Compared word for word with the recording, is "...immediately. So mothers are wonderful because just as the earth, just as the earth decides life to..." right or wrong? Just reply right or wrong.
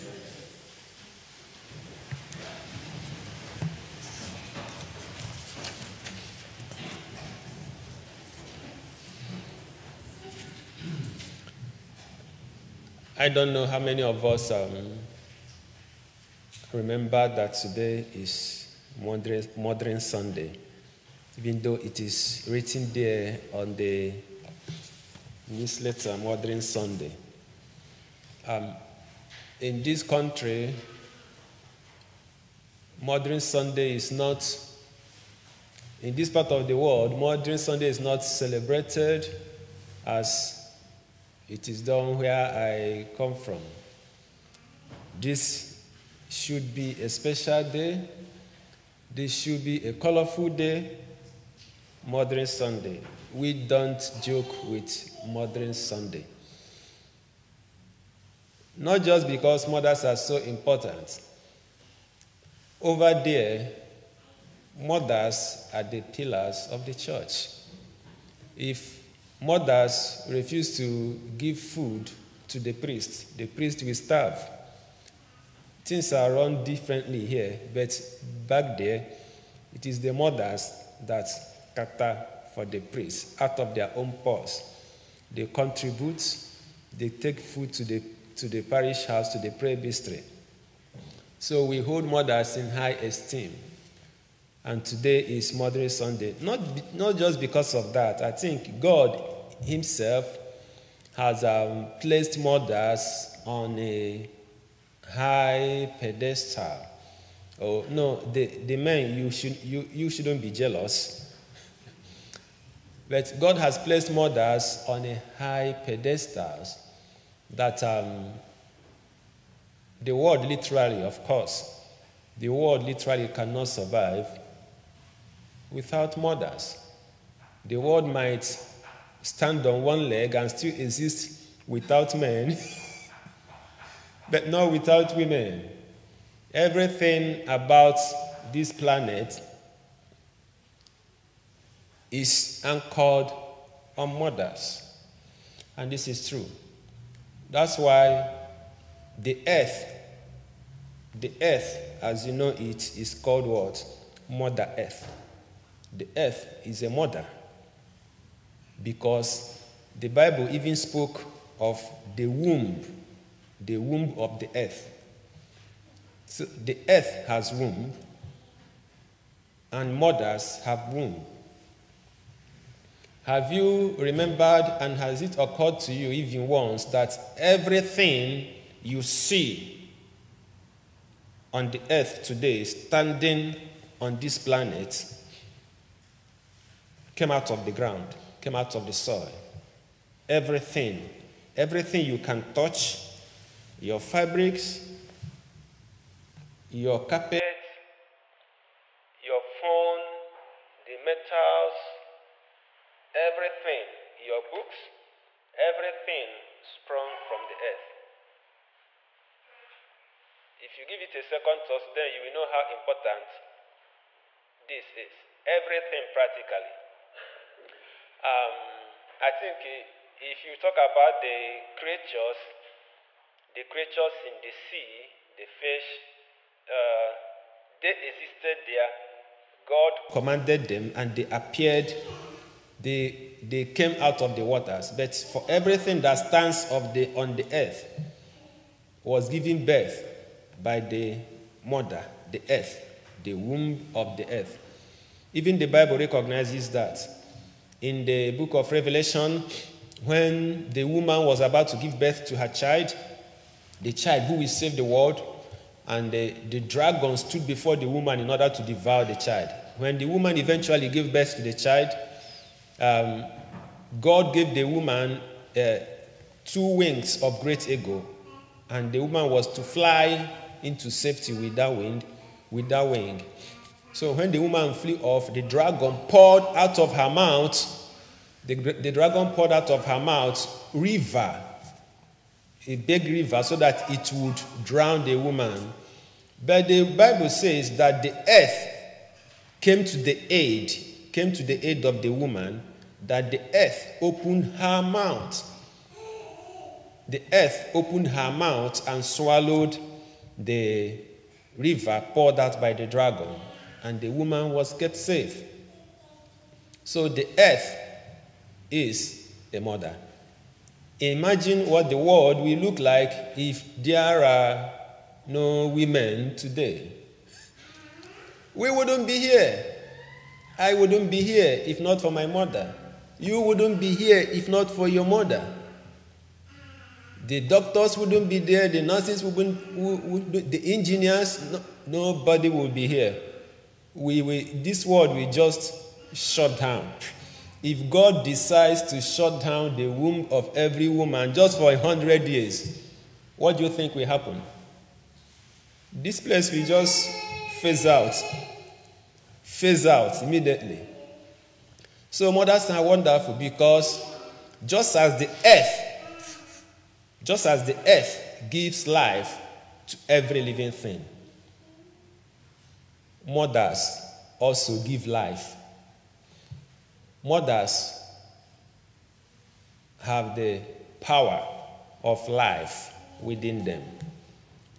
wrong.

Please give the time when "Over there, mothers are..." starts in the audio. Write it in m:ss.
1:02.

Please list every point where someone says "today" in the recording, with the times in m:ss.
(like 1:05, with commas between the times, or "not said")
0:17, 1:34, 3:02, 5:16.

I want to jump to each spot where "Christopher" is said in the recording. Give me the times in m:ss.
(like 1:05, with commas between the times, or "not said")
not said.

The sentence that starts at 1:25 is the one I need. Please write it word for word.
They contribute, they take food to the, to the parish house, to the presbytery.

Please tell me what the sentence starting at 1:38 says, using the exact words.
I think God Himself has um, placed mothers on a high pedestal.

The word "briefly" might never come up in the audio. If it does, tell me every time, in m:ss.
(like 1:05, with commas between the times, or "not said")
not said.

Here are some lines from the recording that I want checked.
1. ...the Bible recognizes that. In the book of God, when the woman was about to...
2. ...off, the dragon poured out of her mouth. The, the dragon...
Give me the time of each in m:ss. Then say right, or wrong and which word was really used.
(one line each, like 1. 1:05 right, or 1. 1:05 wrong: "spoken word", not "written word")
1. 4:05 wrong: "Revelation", not "God"
2. 4:35 right.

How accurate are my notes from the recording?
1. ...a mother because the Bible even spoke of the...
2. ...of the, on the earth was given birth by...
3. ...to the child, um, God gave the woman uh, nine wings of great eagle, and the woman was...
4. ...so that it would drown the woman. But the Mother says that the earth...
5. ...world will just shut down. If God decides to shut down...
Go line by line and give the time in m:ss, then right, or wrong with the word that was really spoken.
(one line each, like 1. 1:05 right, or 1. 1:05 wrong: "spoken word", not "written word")
1. 2:36 right
2. 3:56 right
3. 4:21 wrong: "two", not "nine"
4. 4:43 wrong: "Bible", not "Mother"
5. 5:34 right.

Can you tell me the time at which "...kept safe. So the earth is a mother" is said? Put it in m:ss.
5:04.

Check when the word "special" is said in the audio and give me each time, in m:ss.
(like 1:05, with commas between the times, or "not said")
0:47.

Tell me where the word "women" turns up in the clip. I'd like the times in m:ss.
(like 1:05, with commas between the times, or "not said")
2:15, 5:15.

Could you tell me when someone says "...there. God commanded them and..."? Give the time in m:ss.
3:48.